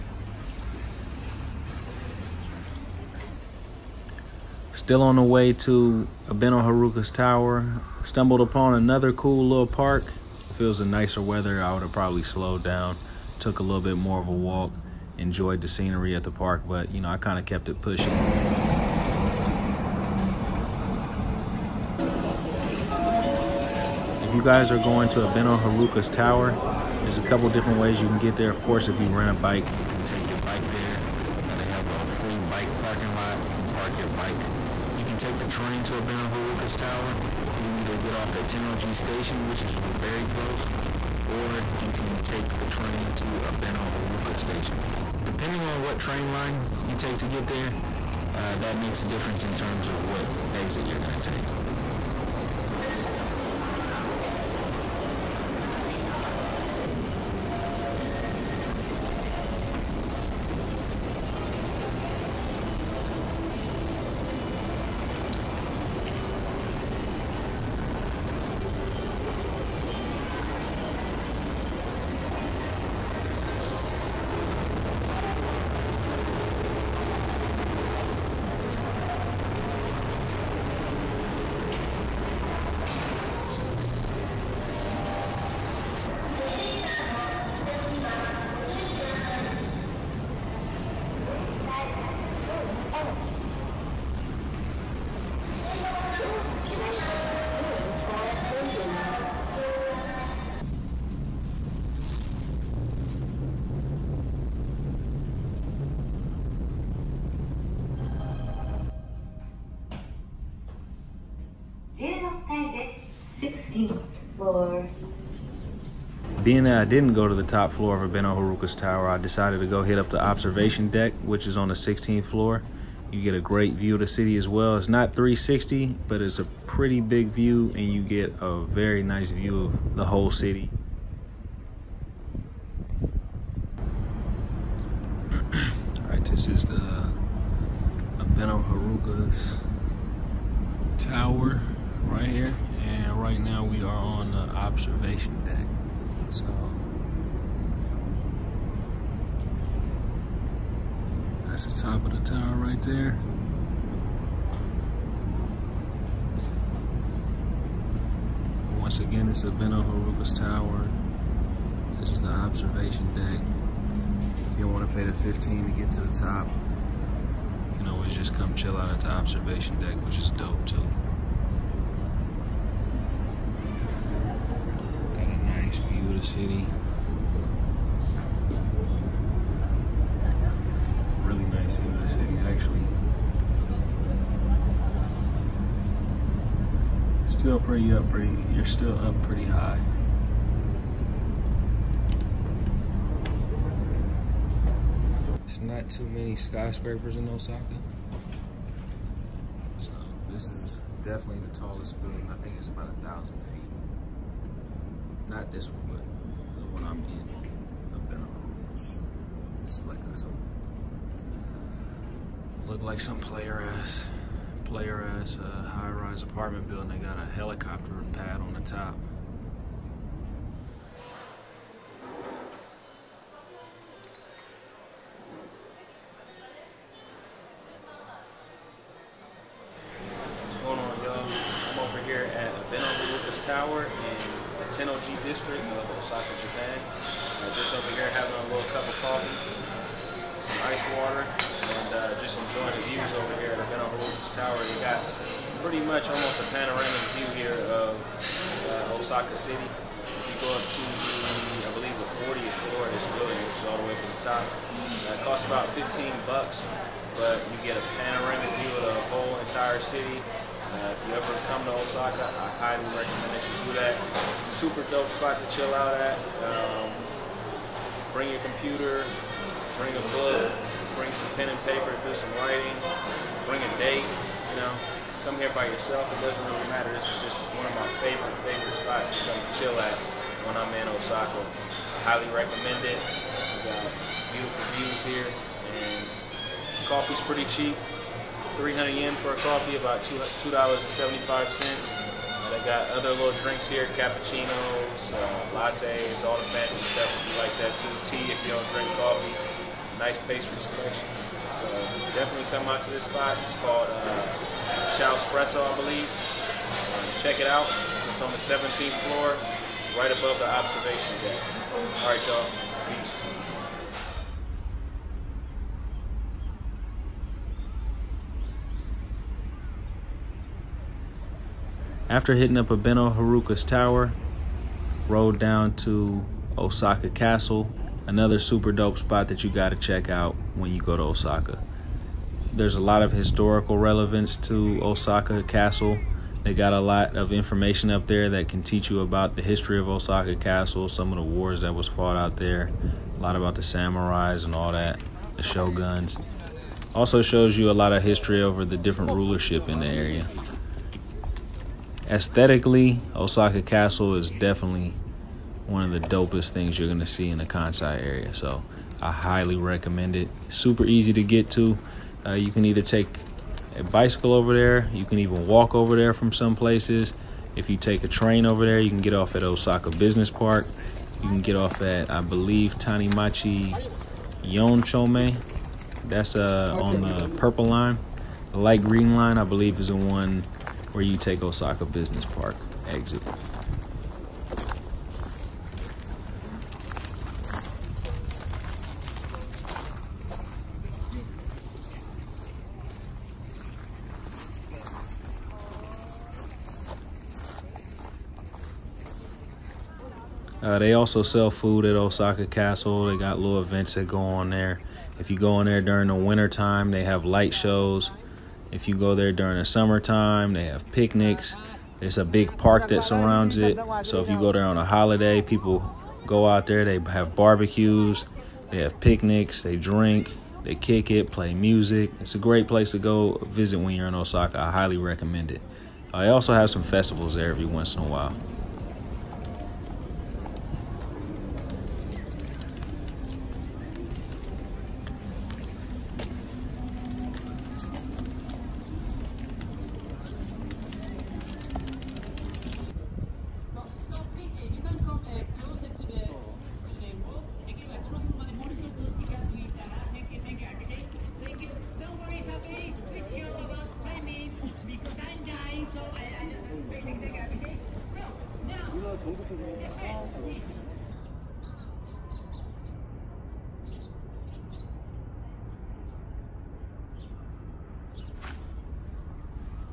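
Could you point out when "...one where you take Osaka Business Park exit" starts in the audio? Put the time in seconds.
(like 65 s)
379 s.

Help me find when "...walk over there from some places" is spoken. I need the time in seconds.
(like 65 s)
365 s.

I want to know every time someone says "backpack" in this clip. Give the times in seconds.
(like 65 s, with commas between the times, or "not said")
not said.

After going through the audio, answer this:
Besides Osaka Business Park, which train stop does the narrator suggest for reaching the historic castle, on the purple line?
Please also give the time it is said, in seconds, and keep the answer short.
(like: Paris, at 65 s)
Tanimachi Yonchome, at 372 s.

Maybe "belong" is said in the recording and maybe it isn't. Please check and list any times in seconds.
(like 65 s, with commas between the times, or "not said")
not said.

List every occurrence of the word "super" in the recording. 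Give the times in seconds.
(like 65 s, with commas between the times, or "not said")
264 s, 328 s, 360 s.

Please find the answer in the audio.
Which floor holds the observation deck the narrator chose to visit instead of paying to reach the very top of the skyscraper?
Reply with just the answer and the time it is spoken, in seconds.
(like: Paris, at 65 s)
16th floor, at 121 s.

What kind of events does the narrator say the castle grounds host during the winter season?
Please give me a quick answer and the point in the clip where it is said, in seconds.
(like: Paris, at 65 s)
light shows, at 407 s.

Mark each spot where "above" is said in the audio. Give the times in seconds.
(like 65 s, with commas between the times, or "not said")
310 s.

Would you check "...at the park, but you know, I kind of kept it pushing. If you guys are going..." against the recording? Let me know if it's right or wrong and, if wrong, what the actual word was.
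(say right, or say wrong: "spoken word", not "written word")
right.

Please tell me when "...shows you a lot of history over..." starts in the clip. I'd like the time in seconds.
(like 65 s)
347 s.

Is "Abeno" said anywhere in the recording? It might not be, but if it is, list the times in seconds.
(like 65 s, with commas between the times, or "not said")
6 s, 25 s, 35 s, 43 s, 118 s, 138 s, 159 s, 322 s.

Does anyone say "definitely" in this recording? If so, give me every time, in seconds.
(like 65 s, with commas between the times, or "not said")
201 s, 302 s, 354 s.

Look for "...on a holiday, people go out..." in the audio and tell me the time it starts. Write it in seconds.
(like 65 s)
414 s.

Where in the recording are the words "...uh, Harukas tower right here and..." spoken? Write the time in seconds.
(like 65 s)
138 s.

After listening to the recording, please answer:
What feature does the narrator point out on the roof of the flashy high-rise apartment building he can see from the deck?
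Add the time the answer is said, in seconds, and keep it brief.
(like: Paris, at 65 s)
helicopter pad, at 217 s.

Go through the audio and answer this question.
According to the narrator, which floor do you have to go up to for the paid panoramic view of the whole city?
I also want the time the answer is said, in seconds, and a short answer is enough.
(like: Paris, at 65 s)
40th floor, at 252 s.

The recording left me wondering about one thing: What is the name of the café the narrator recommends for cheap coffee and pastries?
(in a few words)
Chow Espresso.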